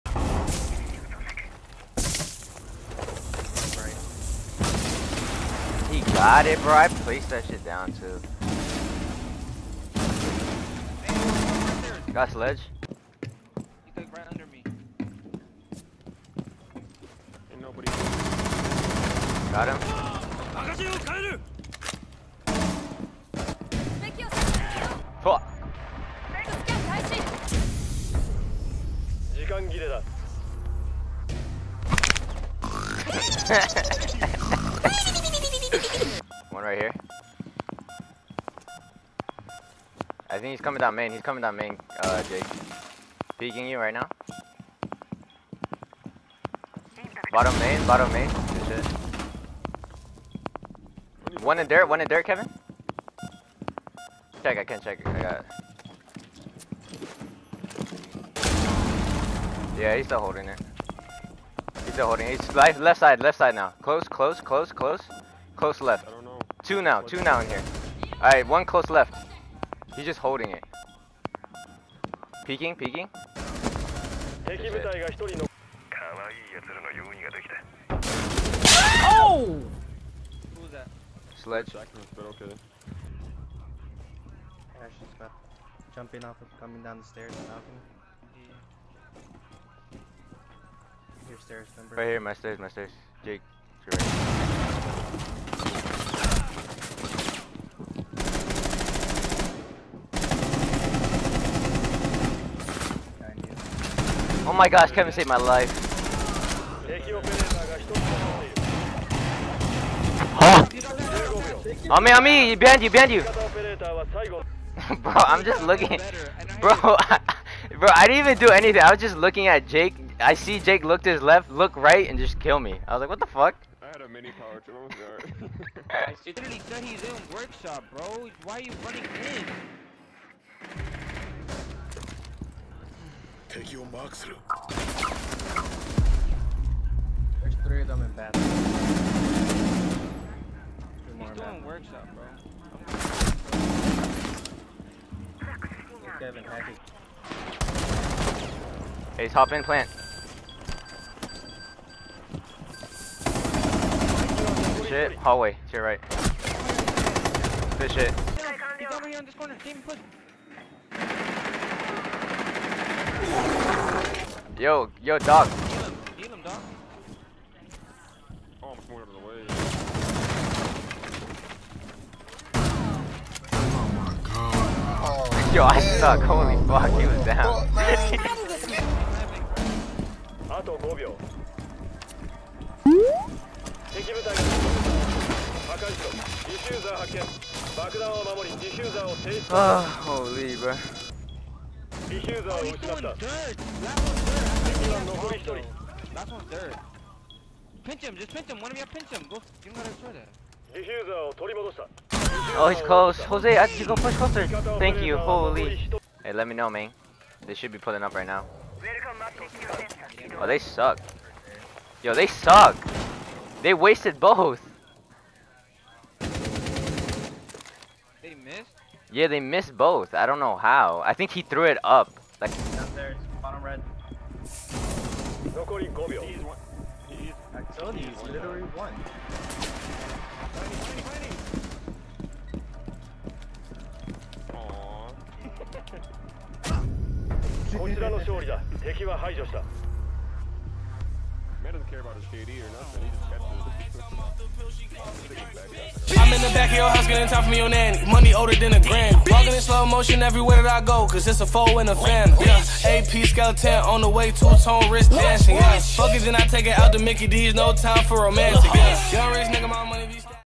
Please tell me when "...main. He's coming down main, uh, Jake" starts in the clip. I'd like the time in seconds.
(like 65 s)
40 s.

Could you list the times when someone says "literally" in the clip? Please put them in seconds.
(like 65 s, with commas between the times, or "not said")
126 s, 228 s.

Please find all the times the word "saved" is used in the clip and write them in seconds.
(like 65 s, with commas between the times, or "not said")
105 s.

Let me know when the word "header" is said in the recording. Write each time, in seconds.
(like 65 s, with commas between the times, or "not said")
not said.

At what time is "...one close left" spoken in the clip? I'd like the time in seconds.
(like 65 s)
68 s.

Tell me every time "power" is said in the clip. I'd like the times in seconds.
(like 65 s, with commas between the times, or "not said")
124 s.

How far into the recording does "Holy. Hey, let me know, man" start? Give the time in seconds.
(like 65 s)
205 s.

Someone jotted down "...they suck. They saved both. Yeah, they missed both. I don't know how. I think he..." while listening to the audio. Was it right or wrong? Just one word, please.
wrong.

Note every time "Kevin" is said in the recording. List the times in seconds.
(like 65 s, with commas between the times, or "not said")
52 s, 104 s.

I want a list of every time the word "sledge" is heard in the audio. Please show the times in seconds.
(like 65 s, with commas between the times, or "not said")
12 s, 81 s.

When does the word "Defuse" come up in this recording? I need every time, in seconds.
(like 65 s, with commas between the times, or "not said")
192 s.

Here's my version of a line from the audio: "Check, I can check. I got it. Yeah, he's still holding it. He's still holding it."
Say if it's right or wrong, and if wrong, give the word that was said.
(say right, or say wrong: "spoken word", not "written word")
right.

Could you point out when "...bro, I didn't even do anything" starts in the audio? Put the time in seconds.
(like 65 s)
117 s.